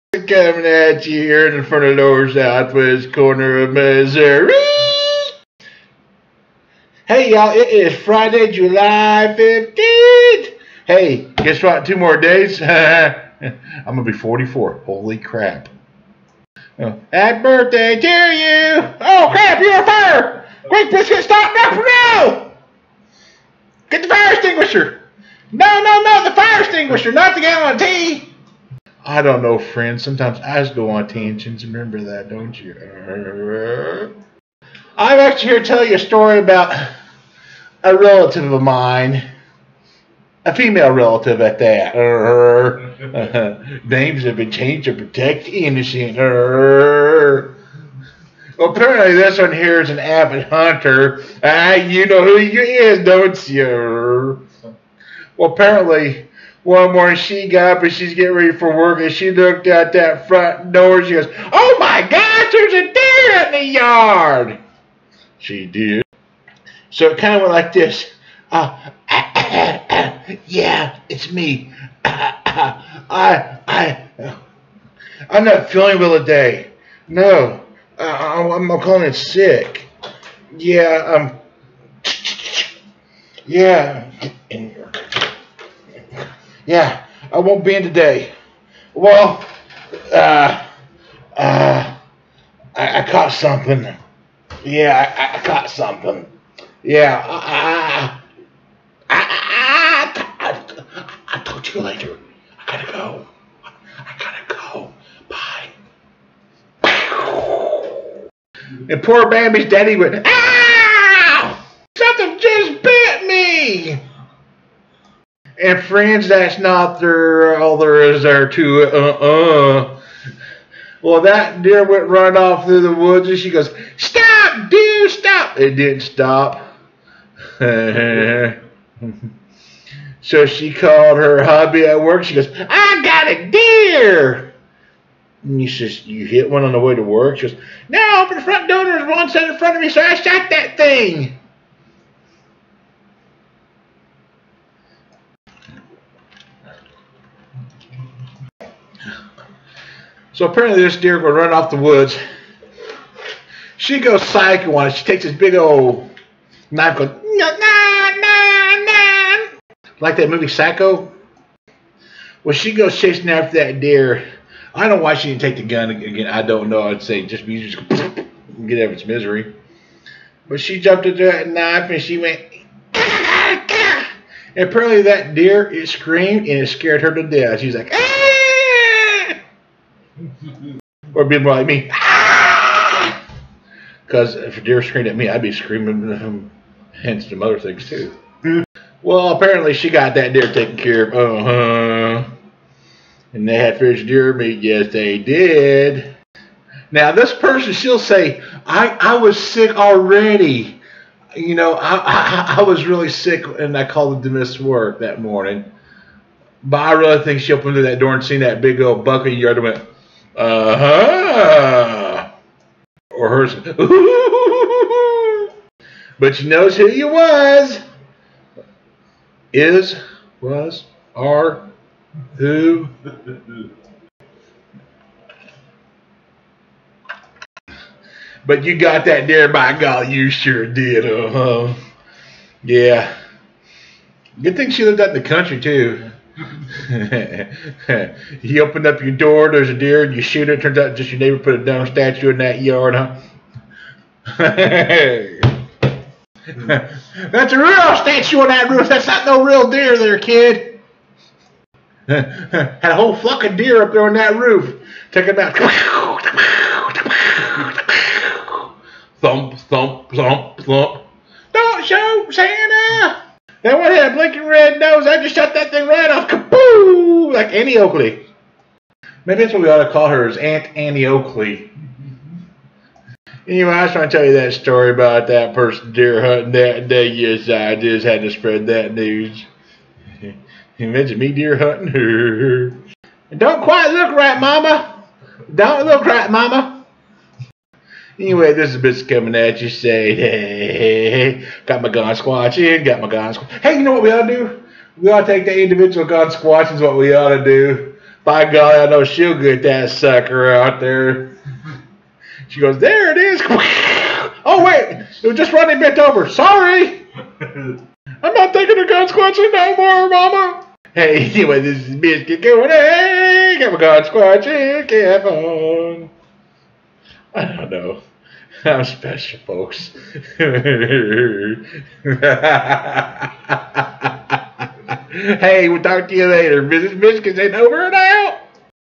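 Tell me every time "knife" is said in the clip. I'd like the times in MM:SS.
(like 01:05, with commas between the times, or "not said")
02:36, 02:51.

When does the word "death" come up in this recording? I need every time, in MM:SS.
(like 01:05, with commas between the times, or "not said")
02:57.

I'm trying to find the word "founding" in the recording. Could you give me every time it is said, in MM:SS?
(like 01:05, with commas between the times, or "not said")
not said.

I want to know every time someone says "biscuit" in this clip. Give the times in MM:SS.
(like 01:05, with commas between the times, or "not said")
00:20, 05:11.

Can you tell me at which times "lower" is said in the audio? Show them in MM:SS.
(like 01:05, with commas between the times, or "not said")
00:01.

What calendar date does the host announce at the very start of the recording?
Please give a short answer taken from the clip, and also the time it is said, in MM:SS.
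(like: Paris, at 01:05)
Friday, July 15th, at 00:07.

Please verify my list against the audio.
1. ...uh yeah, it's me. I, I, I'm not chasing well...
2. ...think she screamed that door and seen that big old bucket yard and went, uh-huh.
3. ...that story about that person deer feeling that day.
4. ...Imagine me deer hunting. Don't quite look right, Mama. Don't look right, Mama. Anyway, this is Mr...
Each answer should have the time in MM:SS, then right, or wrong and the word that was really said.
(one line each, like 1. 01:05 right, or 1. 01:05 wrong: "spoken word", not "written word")
1. 01:09 wrong: "feeling", not "chasing"
2. 03:27 wrong: "opened", not "screamed"
3. 04:34 wrong: "hunting", not "feeling"
4. 04:40 right.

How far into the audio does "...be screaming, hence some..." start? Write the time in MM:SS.
03:05.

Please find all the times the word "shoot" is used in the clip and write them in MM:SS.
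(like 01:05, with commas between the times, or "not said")
04:00, 04:21.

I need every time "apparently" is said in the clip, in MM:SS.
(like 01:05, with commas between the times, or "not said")
00:48, 00:55, 02:30, 02:54, 03:09.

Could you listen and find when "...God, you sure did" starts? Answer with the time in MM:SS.
03:49.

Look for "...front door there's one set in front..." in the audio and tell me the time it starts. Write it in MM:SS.
02:18.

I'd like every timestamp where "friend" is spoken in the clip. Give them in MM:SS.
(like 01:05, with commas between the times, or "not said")
00:29, 01:55.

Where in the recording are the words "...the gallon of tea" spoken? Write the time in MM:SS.
00:27.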